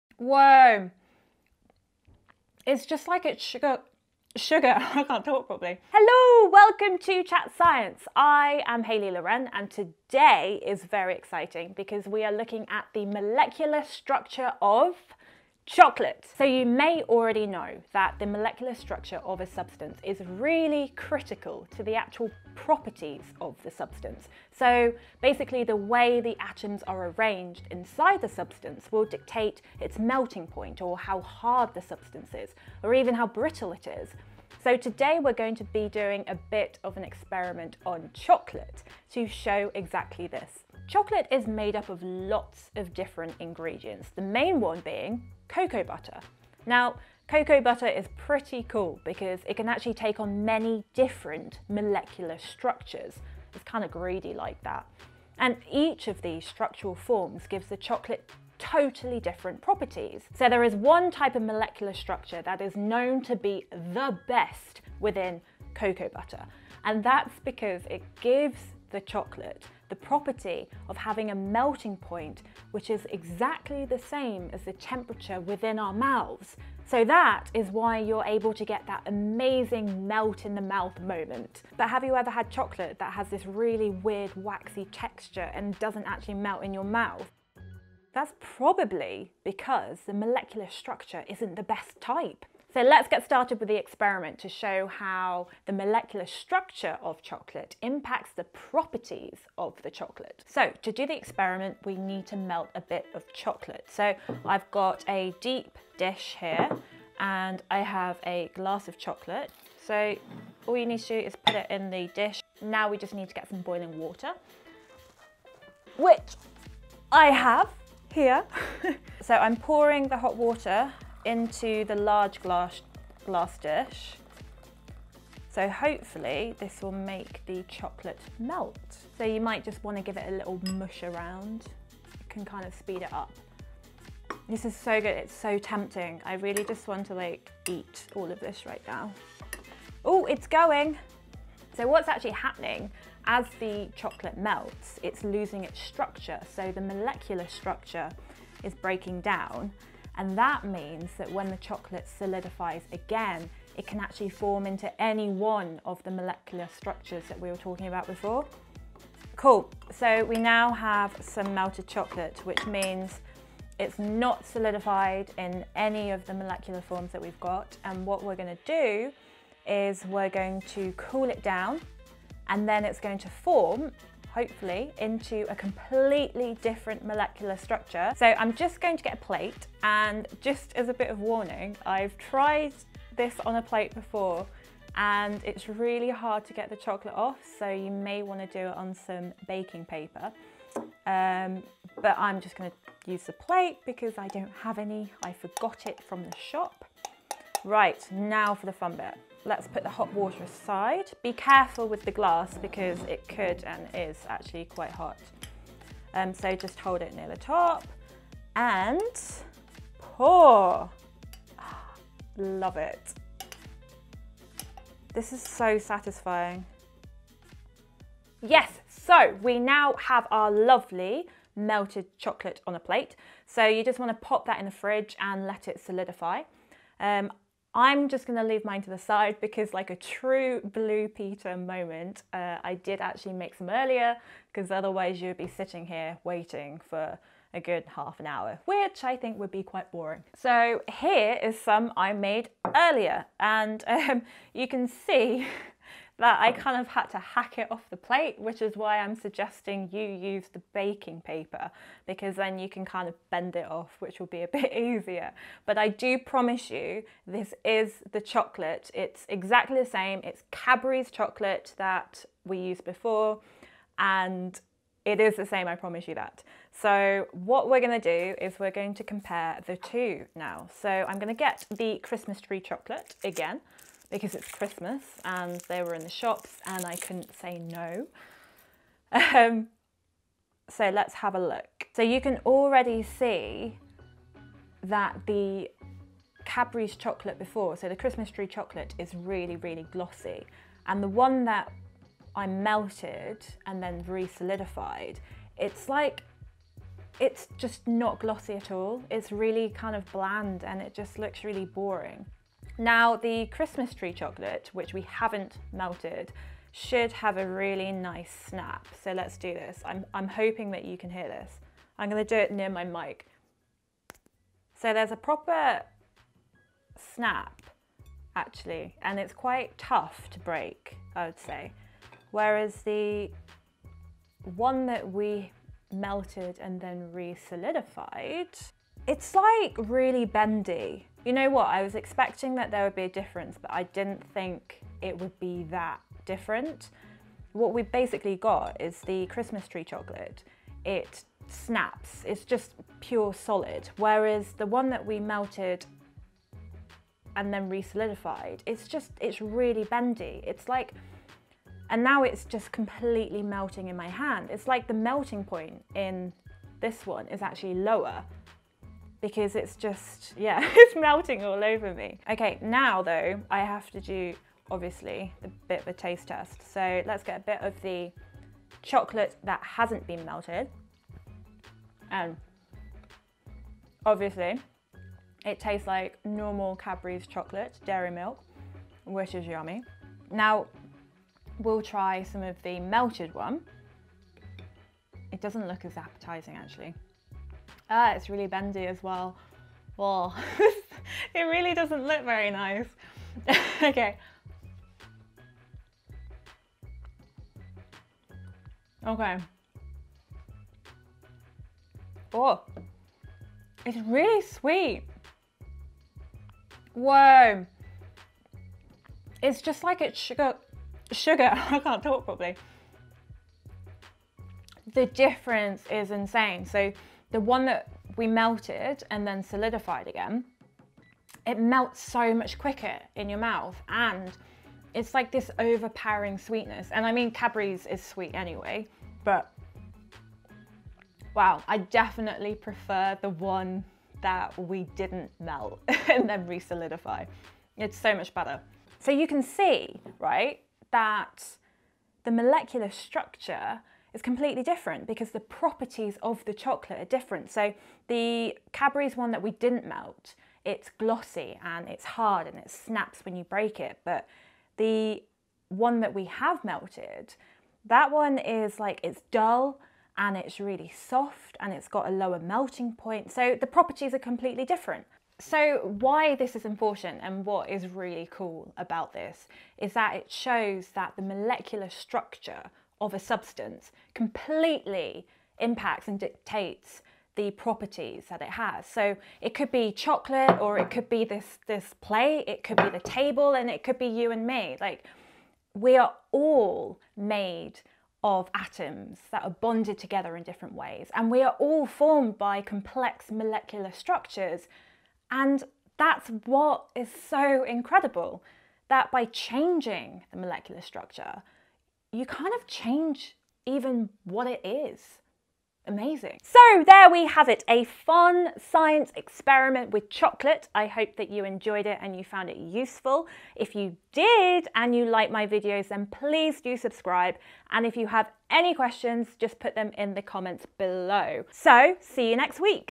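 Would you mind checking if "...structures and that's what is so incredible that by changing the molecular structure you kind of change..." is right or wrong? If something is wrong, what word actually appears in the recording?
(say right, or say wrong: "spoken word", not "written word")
right.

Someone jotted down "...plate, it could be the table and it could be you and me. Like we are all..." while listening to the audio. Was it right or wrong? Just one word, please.
right.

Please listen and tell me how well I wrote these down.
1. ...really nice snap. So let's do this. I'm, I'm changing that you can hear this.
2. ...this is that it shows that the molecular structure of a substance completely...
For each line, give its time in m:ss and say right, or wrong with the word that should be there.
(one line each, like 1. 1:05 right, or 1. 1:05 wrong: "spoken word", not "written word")
1. 5:07 wrong: "hoping", not "changing"
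2. 7:49 right.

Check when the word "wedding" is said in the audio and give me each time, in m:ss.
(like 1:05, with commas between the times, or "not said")
not said.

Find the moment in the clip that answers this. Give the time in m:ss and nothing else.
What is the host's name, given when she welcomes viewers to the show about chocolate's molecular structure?
0:08.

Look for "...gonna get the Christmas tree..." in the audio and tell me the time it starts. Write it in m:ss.
4:31.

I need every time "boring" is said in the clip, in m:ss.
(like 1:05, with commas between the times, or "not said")
3:59, 5:01.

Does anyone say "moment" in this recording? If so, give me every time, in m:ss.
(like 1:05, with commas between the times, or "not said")
1:21, 3:51.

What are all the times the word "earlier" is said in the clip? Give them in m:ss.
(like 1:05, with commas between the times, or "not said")
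3:53, 4:02.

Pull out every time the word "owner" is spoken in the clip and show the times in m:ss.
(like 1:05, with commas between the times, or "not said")
not said.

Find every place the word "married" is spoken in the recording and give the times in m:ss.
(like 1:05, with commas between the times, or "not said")
not said.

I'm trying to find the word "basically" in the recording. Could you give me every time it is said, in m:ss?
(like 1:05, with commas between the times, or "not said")
0:25, 5:37.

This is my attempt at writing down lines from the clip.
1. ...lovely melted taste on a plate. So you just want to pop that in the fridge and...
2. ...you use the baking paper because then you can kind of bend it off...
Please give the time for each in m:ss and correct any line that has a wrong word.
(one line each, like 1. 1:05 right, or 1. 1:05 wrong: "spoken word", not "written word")
1. 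3:40 wrong: "chocolate", not "taste"
2. 4:09 right.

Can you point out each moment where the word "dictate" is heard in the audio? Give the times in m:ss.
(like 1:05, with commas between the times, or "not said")
0:29, 7:56.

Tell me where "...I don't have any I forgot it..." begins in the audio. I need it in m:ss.
3:14.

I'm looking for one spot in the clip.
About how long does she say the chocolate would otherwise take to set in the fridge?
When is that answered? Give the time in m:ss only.
3:57.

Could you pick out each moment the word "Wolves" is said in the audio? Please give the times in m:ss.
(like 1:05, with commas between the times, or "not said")
not said.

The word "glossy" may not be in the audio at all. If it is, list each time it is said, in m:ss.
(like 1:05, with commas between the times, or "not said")
4:49, 4:58, 7:30.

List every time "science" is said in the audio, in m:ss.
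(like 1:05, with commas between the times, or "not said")
0:07, 8:28.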